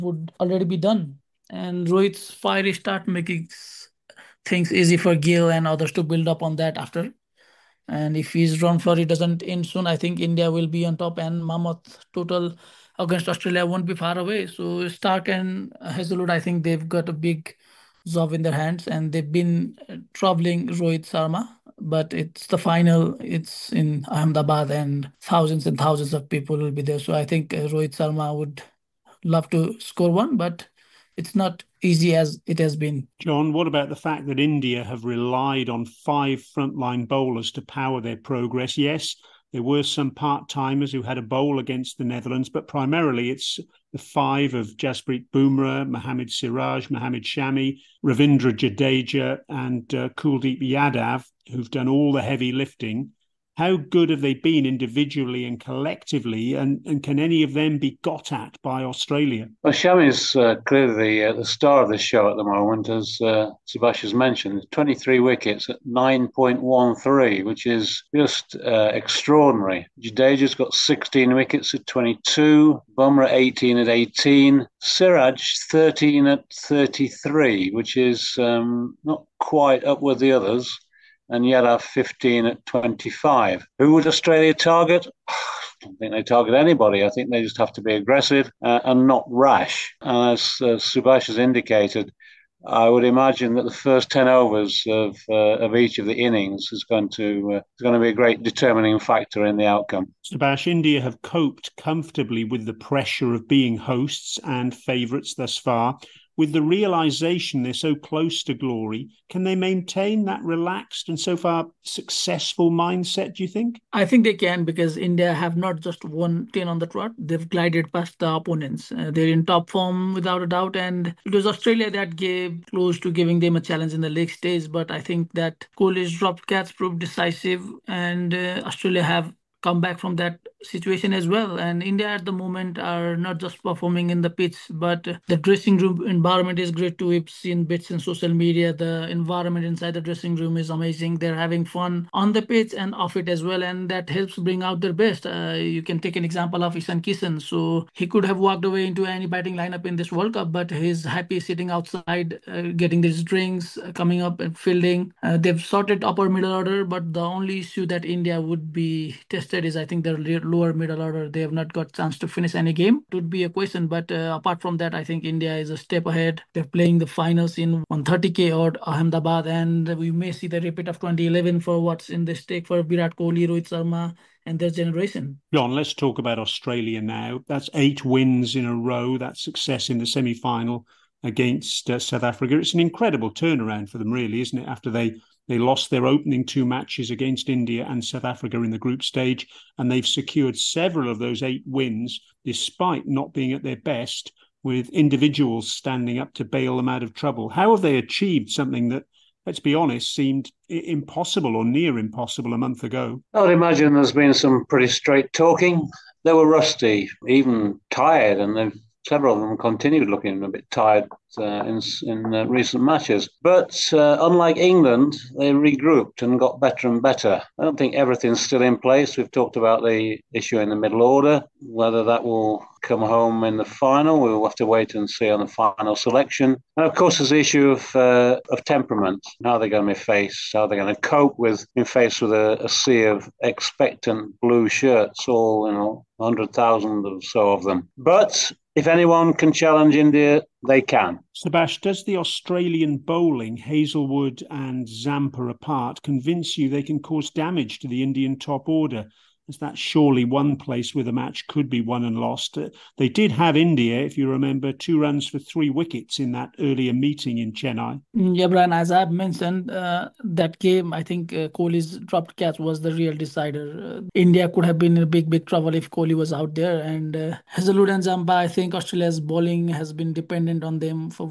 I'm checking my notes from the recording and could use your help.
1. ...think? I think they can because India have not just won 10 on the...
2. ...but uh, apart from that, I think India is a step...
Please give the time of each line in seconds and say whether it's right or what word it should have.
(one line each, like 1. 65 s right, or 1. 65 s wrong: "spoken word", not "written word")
1. 113 s right
2. 163 s right.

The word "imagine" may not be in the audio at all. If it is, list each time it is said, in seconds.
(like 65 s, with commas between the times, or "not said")
93 s, 203 s.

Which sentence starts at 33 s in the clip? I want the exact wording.
Jon, what about the fact that India have relied on five frontline bowlers to power their progress?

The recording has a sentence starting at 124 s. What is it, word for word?
But I think that Kohli's dropped catch proved decisive, and uh, Australia have come back from that situation as well.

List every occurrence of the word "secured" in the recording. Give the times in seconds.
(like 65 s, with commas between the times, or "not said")
190 s.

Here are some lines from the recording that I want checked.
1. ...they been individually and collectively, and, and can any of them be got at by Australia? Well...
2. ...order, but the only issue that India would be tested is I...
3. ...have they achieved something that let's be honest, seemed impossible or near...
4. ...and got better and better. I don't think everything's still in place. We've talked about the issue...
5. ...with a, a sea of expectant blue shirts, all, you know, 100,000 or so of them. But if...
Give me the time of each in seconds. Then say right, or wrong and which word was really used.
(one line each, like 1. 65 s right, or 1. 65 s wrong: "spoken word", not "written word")
1. 54 s right
2. 156 s right
3. 197 s right
4. 216 s right
5. 232 s right.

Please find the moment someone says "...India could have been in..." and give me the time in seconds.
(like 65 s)
264 s.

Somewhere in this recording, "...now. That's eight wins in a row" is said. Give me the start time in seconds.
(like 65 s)
177 s.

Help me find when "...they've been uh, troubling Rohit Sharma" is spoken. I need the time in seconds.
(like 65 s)
19 s.